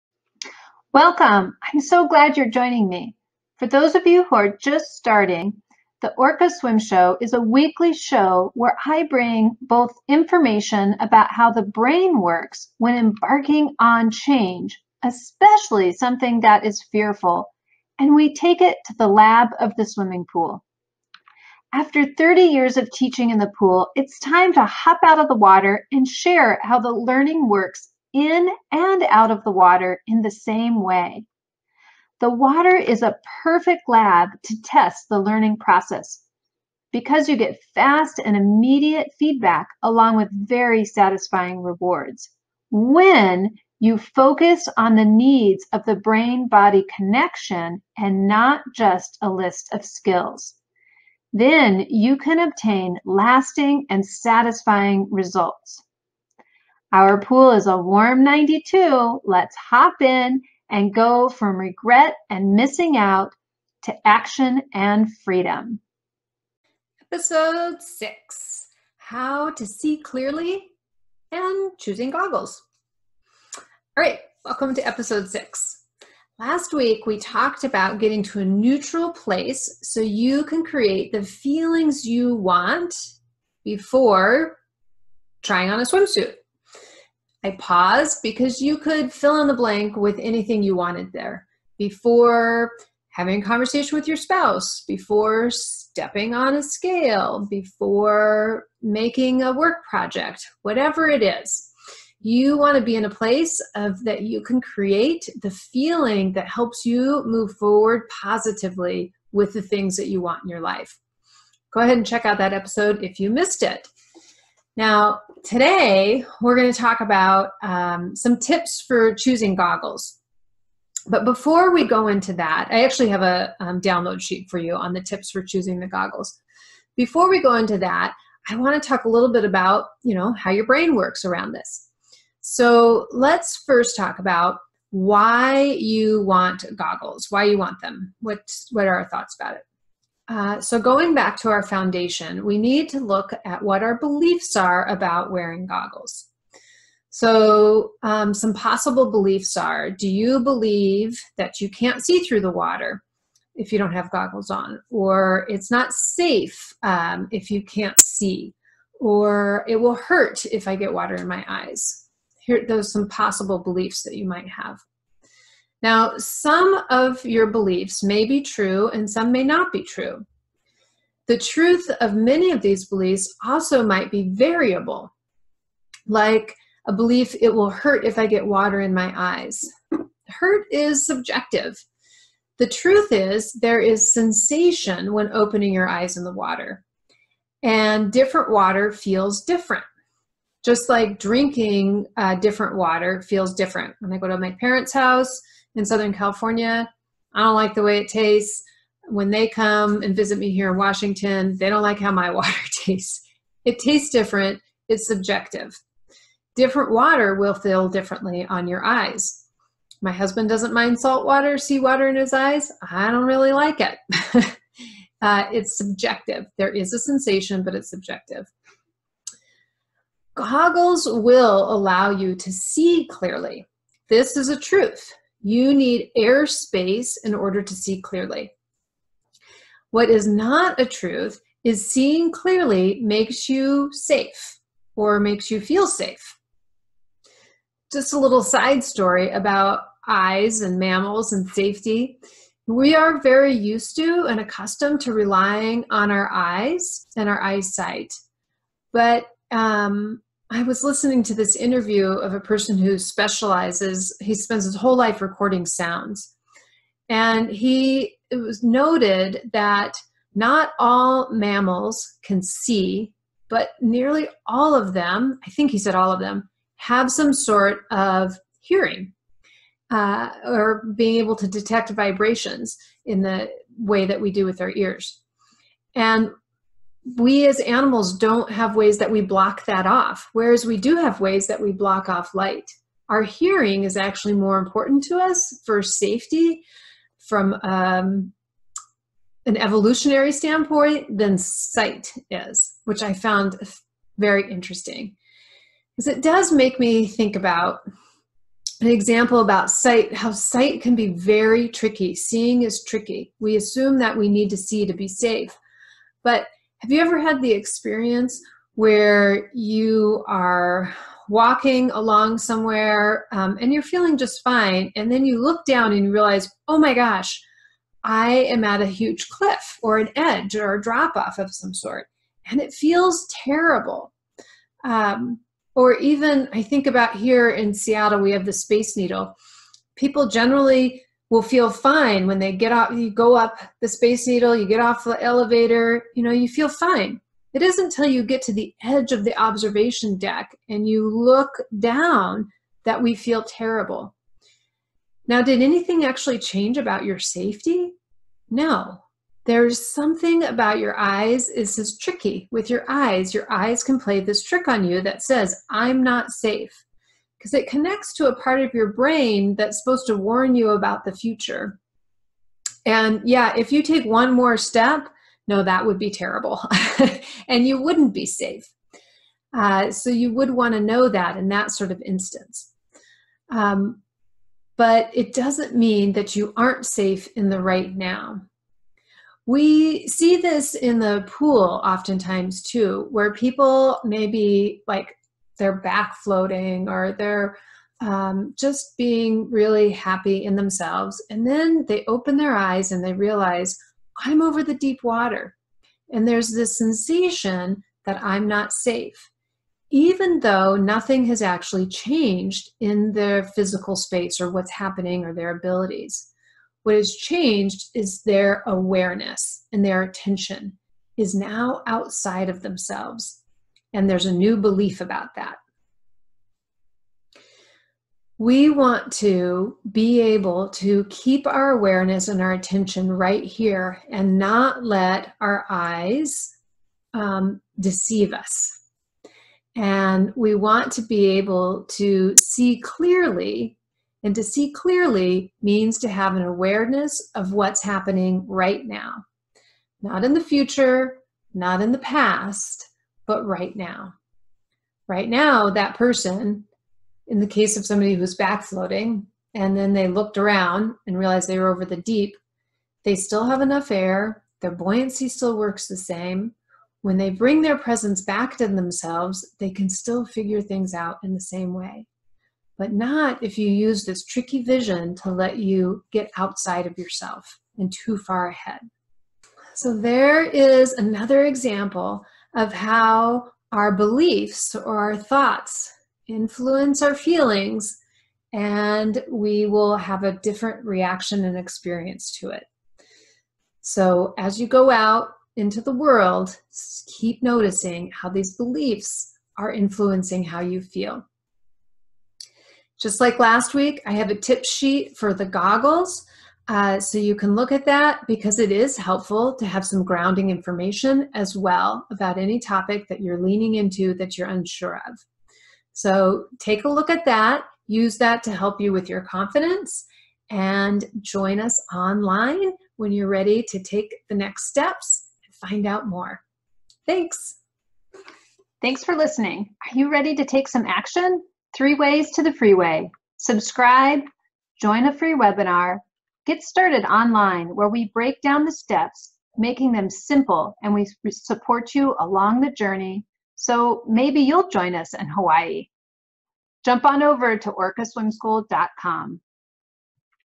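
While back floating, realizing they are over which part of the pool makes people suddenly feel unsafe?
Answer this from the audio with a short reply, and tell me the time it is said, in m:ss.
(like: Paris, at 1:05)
The deep water, at 6:34.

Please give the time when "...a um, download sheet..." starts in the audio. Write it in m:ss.
2:03.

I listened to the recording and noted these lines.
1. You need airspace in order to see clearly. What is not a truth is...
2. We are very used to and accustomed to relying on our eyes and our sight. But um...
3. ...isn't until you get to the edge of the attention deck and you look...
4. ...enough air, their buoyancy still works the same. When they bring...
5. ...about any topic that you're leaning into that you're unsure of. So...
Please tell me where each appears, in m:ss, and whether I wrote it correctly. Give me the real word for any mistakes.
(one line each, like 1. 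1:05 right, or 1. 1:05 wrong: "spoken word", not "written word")
1. 3:45 right
2. 4:02 wrong: "eyesight", not "sight"
3. 5:37 wrong: "observation", not "attention"
4. 7:33 right
5. 8:22 right.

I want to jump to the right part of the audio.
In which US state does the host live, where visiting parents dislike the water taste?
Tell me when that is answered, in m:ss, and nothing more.
3:20.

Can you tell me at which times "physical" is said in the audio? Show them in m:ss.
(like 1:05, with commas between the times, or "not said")
6:43.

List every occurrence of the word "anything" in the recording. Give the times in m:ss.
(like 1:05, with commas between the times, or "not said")
1:30, 5:45.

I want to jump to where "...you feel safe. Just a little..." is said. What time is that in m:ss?
3:55.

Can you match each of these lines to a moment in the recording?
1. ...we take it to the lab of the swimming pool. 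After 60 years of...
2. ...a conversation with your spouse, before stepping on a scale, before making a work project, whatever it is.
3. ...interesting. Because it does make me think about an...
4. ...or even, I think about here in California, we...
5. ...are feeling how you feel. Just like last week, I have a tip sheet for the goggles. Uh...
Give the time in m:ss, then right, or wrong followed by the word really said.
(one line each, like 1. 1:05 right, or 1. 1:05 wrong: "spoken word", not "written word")
1. 0:18 wrong: "30", not "60"
2. 1:33 right
3. 4:54 right
4. 5:25 wrong: "Seattle", not "California"
5. 8:09 wrong: "influencing", not "feeling".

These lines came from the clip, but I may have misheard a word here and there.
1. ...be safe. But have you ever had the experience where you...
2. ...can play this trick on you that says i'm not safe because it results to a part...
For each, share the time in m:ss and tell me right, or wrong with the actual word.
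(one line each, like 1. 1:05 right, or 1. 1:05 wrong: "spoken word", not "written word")
1. 5:04 right
2. 5:53 wrong: "connects", not "results".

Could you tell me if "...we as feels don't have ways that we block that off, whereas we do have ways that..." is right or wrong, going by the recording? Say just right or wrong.
wrong.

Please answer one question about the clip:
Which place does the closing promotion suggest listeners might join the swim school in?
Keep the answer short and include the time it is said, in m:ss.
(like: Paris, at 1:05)
Hawaii, at 8:55.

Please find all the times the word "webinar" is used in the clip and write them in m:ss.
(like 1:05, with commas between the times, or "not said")
8:45.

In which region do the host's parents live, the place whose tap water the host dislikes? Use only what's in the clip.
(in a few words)
Southern California.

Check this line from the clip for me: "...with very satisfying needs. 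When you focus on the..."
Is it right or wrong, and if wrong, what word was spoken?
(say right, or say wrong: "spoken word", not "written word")
wrong: "rewards", not "needs".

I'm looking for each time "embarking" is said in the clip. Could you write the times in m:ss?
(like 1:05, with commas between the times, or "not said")
0:12.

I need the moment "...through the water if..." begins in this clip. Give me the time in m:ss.
2:32.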